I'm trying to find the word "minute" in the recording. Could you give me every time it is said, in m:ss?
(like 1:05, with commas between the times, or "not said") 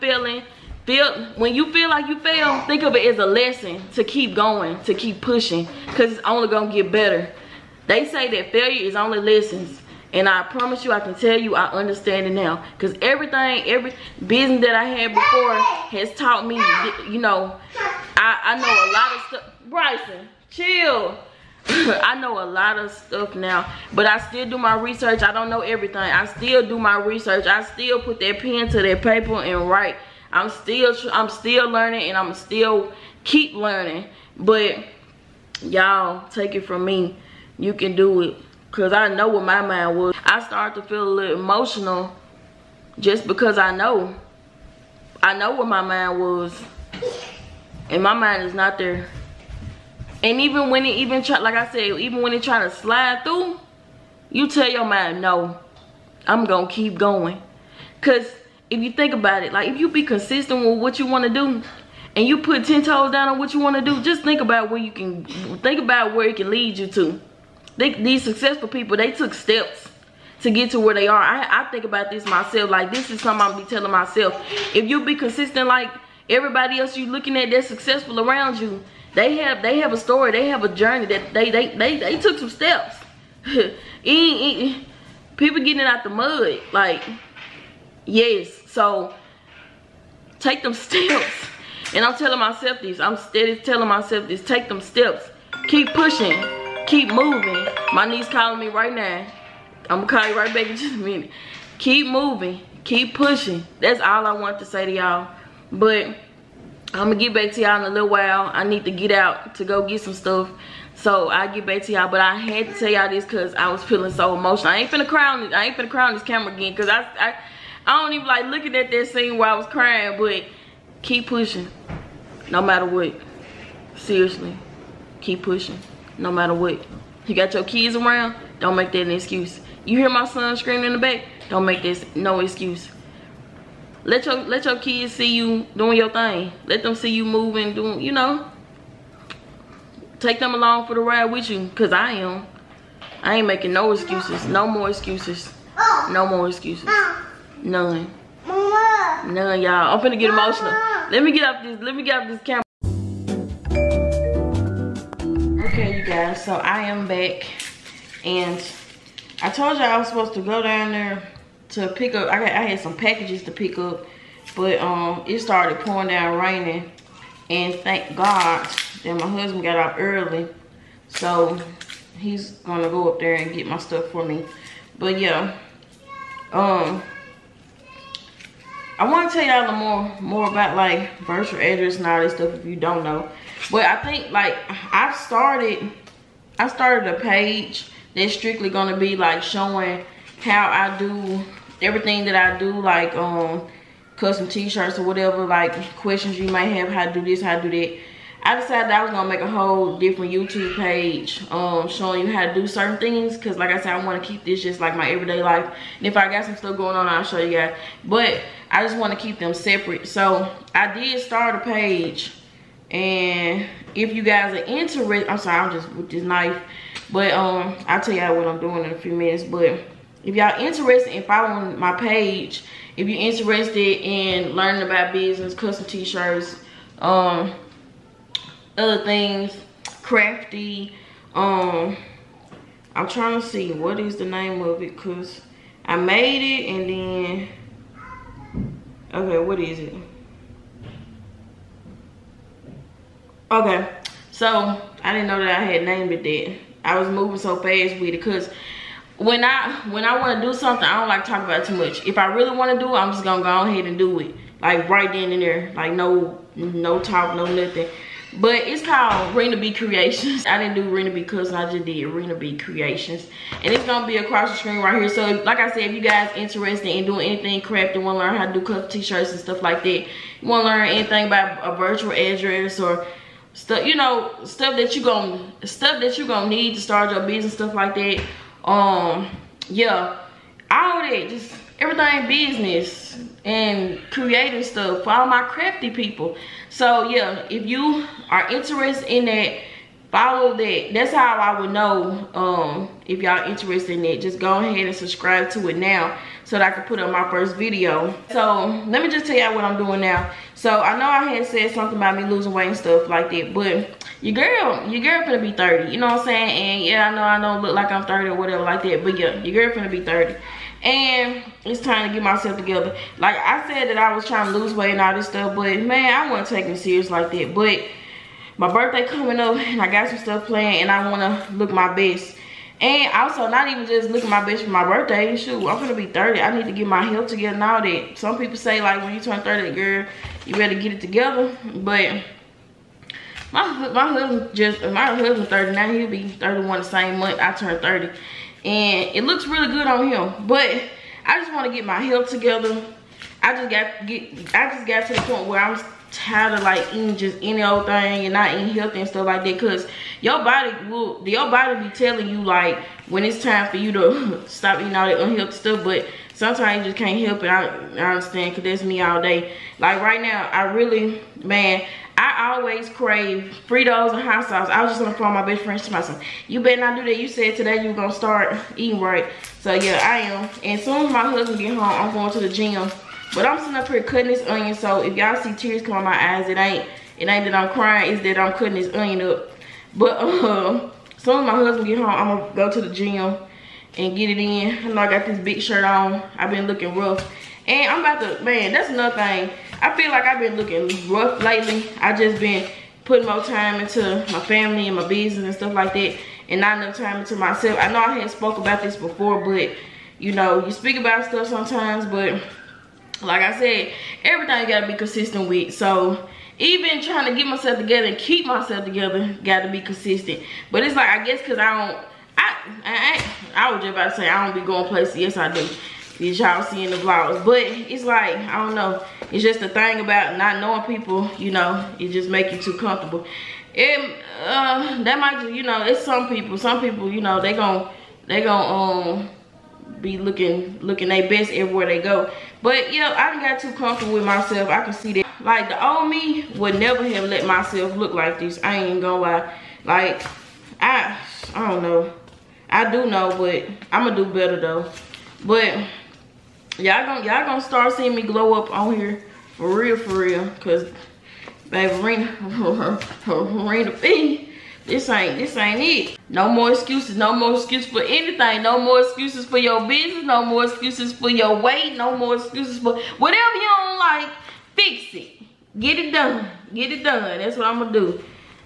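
1:40, 3:39.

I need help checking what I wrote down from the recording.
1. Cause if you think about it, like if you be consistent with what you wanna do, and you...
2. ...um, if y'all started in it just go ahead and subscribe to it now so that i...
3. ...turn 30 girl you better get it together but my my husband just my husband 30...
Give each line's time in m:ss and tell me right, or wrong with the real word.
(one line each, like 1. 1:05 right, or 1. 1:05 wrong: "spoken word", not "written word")
1. 0:58 right
2. 4:52 wrong: "interested", not "started"
3. 5:29 right.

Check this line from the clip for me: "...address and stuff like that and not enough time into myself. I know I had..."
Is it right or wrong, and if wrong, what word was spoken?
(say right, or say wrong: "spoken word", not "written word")
wrong: "business", not "address".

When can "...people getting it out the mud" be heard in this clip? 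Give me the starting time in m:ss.
1:23.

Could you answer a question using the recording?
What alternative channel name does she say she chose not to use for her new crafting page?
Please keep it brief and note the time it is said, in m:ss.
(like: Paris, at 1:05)
Rina B Cooks, at 4:20.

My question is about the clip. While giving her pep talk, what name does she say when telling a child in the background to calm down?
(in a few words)
Bryson.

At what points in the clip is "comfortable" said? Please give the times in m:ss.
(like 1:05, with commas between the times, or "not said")
7:02, 7:13.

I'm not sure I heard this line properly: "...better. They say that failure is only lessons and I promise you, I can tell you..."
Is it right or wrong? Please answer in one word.
right.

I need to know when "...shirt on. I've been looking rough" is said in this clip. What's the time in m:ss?
6:25.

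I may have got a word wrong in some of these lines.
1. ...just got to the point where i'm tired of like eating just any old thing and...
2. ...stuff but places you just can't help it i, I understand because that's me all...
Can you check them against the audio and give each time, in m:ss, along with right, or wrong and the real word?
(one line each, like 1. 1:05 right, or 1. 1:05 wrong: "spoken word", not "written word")
1. 5:44 right
2. 5:55 wrong: "sometimes", not "places".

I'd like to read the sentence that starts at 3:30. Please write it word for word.
So I did start a page and if you guys are interested, I'm sorry, I'm just with this knife.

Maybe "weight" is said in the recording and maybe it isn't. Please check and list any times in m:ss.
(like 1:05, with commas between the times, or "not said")
5:02, 5:14, 7:41.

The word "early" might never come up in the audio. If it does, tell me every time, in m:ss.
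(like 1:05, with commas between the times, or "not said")
2:49.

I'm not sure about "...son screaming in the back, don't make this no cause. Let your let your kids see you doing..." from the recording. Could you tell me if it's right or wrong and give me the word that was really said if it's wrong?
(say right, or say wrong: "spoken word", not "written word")
wrong: "excuse", not "cause".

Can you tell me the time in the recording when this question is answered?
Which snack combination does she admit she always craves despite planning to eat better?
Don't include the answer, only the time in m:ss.
6:03.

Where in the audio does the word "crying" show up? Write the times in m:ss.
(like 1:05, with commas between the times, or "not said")
1:59, 6:17.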